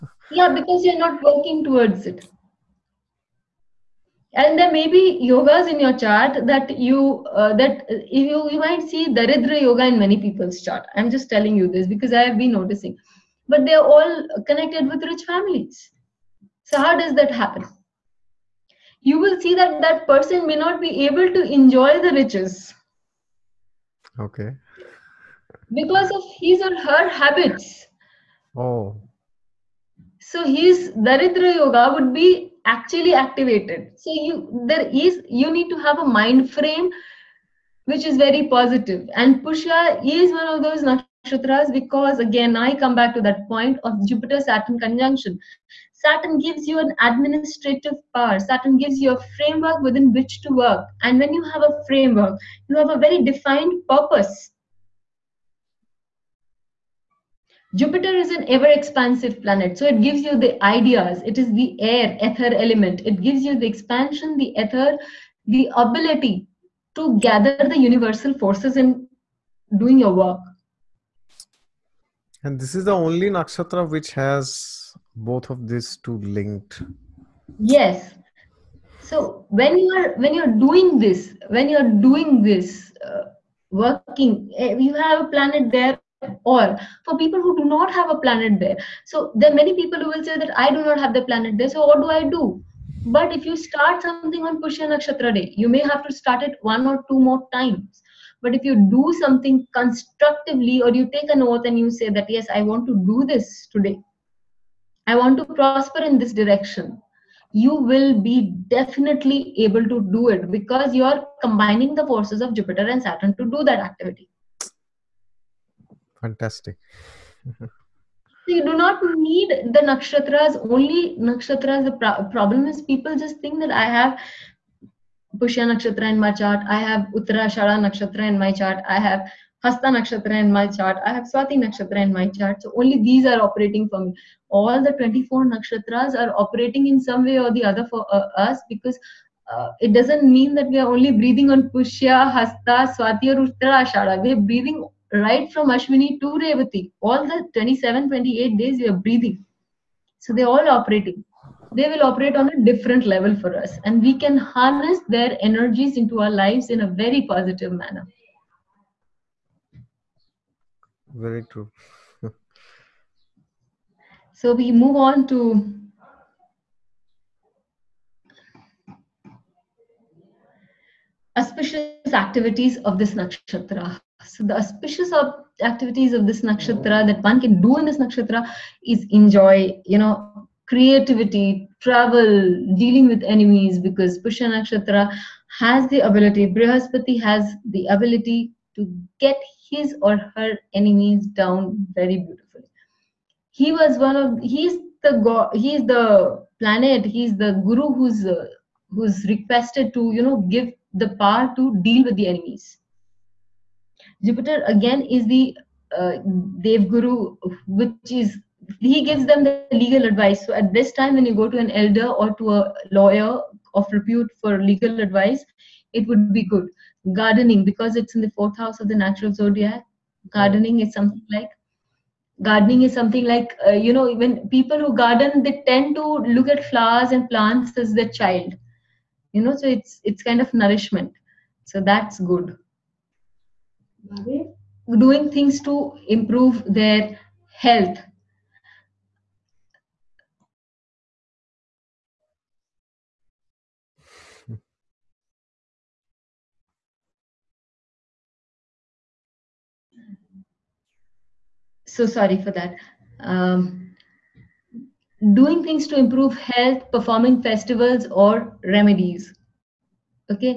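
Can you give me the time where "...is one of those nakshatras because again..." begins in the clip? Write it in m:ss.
0:40.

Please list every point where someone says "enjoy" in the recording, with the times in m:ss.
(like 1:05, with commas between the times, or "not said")
0:21, 2:59.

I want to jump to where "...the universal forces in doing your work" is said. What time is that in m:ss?
1:07.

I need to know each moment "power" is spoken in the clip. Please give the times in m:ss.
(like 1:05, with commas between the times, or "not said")
0:48, 3:21.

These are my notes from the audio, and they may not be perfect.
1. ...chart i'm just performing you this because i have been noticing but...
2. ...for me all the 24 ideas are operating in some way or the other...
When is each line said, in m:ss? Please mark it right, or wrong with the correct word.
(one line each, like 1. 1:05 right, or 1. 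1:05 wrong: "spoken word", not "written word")
1. 0:10 wrong: "telling", not "performing"
2. 2:13 wrong: "nakshatras", not "ideas".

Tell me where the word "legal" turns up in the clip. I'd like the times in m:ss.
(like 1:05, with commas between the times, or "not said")
3:29, 3:34.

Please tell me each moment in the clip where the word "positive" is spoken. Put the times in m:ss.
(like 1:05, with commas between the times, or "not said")
0:38, 2:37.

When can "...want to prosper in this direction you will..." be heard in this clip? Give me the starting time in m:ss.
1:45.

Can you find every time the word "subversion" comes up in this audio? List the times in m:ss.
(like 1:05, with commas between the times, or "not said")
not said.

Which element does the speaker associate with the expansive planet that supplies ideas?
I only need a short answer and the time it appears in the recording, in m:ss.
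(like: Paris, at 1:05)
Air, ether, at 1:01.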